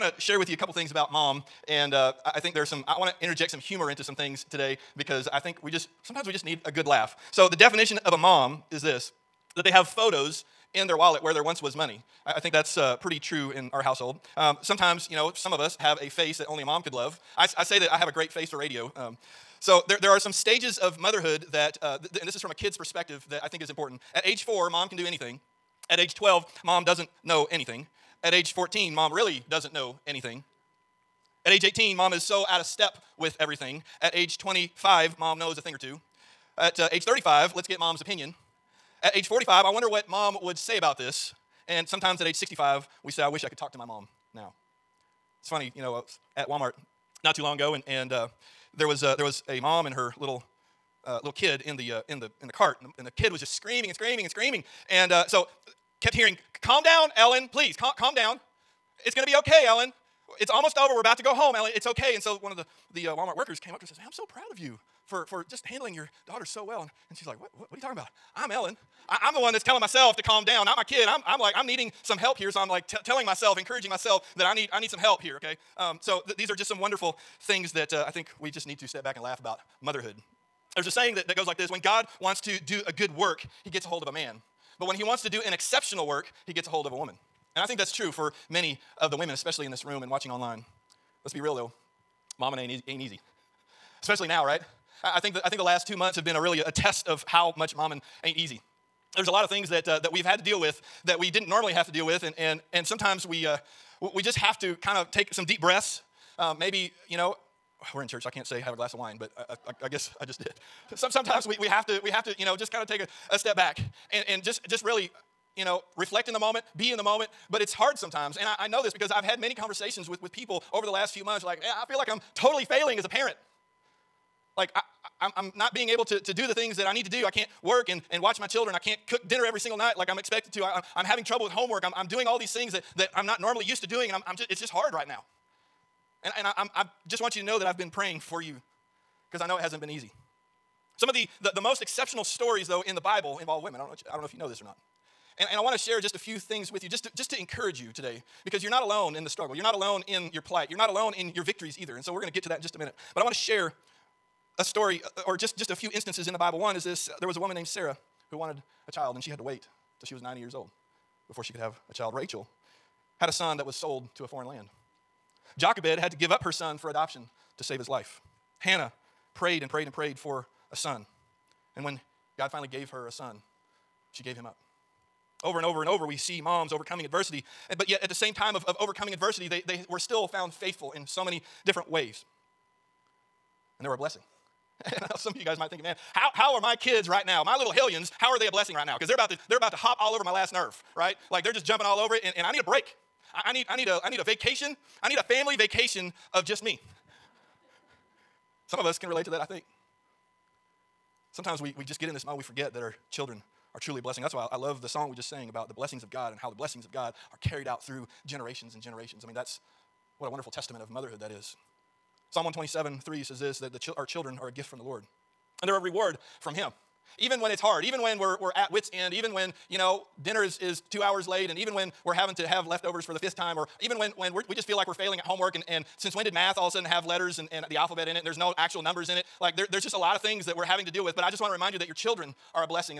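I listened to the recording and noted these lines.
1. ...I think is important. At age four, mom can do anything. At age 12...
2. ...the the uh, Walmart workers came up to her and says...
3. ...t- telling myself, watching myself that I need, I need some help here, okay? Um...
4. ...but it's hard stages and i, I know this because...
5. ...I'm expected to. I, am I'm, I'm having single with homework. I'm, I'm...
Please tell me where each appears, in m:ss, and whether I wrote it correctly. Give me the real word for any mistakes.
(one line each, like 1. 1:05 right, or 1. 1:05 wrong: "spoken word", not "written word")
1. 0:23 right
2. 1:02 right
3. 1:12 wrong: "encouraging", not "watching"
4. 1:57 wrong: "sometimes", not "stages"
5. 2:10 wrong: "trouble", not "single".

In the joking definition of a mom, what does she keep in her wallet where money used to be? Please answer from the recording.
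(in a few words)
photos.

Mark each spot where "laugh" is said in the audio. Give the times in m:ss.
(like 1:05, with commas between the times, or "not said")
0:06, 1:19.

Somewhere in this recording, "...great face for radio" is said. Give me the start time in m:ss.
0:18.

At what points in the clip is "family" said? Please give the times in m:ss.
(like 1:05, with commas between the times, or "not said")
3:15.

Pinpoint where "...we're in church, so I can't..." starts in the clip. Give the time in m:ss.
1:47.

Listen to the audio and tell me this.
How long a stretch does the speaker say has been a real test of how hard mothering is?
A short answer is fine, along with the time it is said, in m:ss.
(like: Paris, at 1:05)
2 months, at 1:35.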